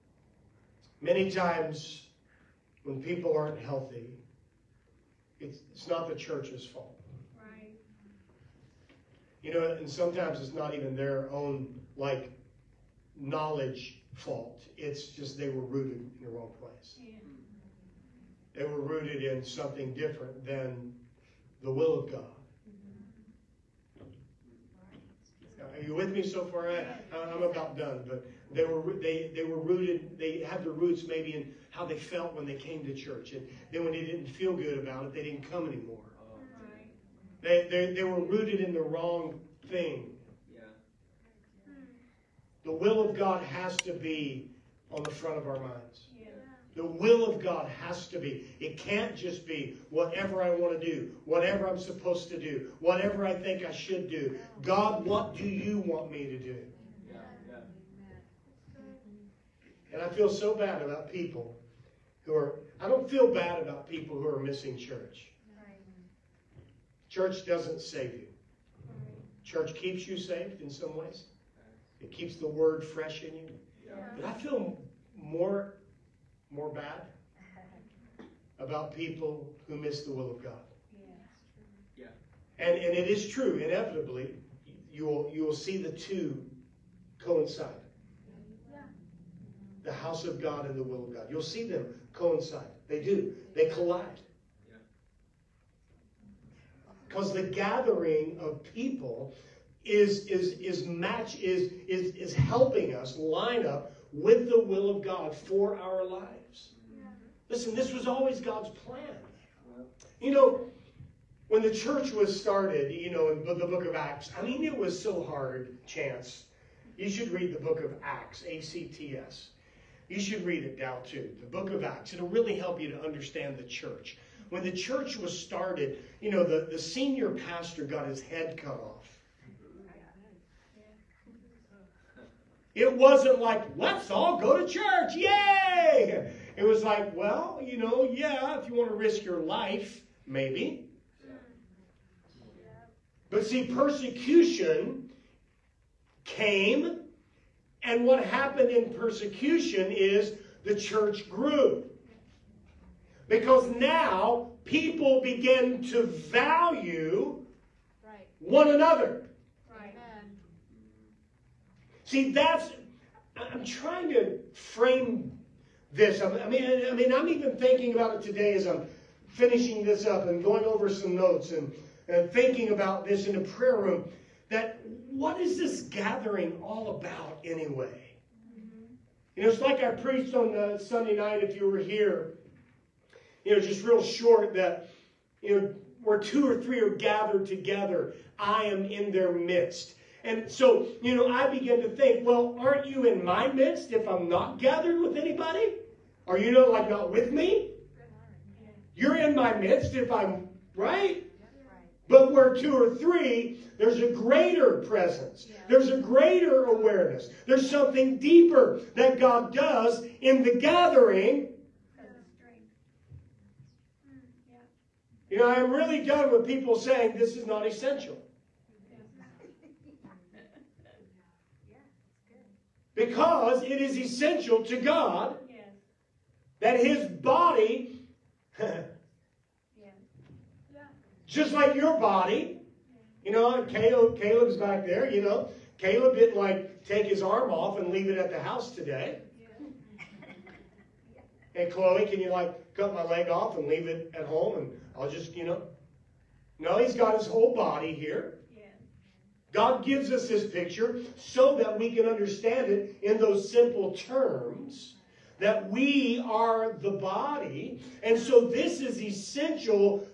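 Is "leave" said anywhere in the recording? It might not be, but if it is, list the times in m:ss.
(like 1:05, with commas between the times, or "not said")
3:57, 4:03.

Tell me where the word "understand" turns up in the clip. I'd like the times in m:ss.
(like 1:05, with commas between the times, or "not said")
2:03, 4:12.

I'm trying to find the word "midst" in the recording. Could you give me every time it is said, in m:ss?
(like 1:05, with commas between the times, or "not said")
3:09, 3:13, 3:19.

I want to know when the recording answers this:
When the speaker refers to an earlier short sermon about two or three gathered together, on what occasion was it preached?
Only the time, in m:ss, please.
3:00.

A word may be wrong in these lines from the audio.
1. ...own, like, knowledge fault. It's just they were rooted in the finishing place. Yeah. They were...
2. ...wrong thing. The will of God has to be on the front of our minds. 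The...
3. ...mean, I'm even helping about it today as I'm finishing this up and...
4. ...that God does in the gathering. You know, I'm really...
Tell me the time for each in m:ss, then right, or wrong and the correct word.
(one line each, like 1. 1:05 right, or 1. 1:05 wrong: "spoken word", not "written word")
1. 0:11 wrong: "wrong", not "finishing"
2. 0:38 right
3. 2:46 wrong: "thinking", not "helping"
4. 3:28 right.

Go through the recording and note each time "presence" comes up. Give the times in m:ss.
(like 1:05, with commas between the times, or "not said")
3:24.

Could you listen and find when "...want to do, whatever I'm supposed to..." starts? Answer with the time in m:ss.
0:50.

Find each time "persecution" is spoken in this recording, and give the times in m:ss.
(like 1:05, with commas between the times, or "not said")
2:23, 2:28.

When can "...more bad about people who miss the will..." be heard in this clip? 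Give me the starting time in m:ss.
1:16.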